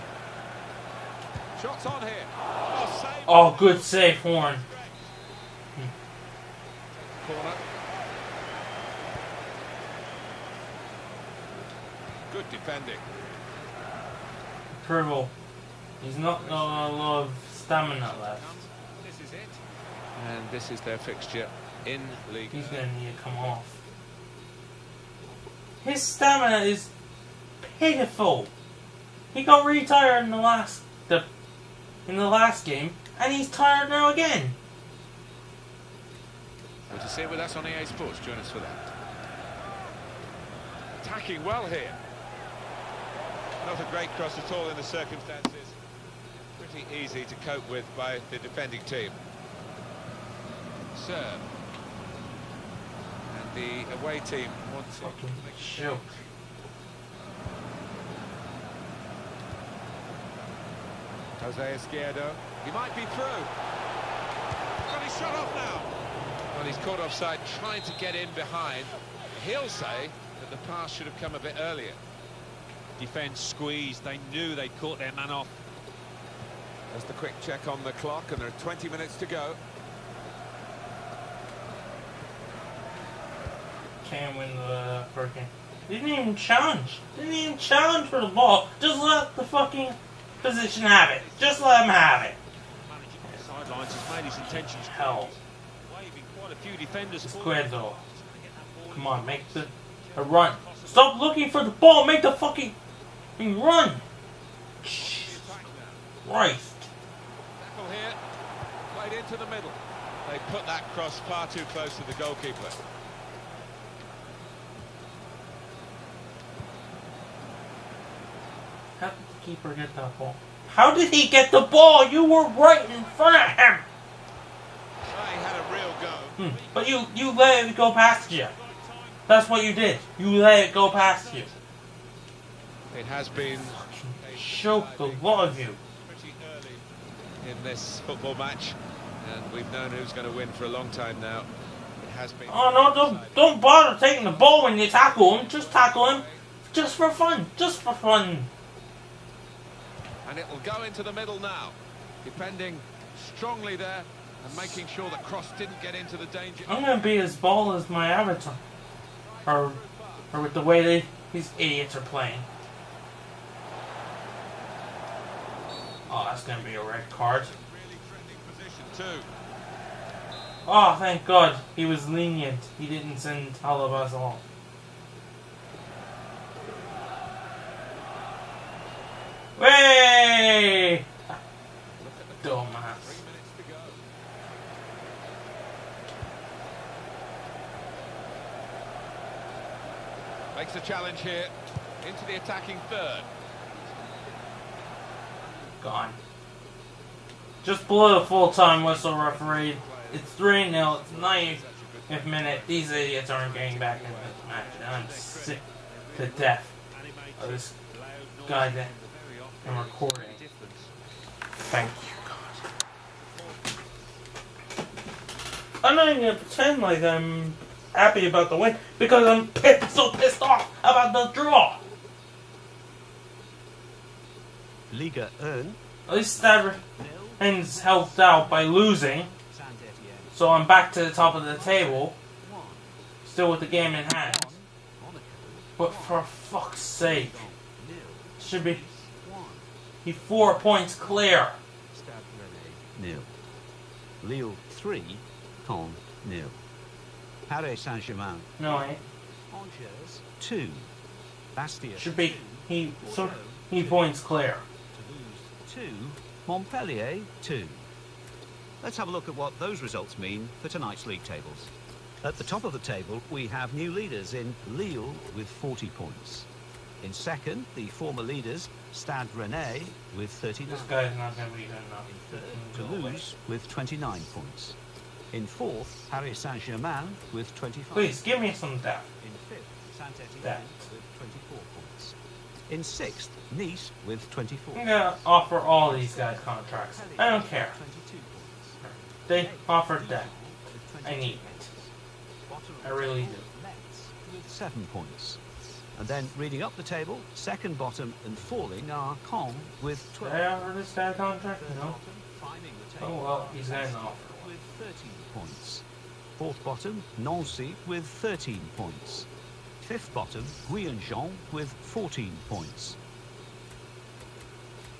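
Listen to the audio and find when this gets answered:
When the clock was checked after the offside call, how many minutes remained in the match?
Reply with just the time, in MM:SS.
01:18.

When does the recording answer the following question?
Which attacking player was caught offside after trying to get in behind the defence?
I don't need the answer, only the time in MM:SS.
01:01.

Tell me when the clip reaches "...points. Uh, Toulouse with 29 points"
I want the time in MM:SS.
04:30.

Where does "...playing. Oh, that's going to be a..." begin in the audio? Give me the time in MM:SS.
02:42.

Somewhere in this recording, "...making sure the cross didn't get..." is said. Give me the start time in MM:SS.
02:34.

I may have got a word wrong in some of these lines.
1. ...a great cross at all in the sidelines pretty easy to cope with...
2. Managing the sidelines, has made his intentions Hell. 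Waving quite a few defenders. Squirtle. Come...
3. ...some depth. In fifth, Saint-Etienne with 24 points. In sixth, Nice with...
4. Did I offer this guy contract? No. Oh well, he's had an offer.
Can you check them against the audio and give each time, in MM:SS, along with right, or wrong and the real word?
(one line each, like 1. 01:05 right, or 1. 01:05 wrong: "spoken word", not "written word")
1. 00:43 wrong: "circumstances", not "sidelines"
2. 01:32 right
3. 04:38 right
4. 05:00 right.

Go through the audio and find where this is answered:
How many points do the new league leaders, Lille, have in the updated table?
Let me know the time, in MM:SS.
04:25.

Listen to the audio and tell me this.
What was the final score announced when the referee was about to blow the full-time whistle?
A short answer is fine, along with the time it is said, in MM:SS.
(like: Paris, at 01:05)
3-0, at 03:20.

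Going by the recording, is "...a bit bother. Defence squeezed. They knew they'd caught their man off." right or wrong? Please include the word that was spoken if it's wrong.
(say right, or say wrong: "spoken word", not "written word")
wrong: "earlier", not "bother".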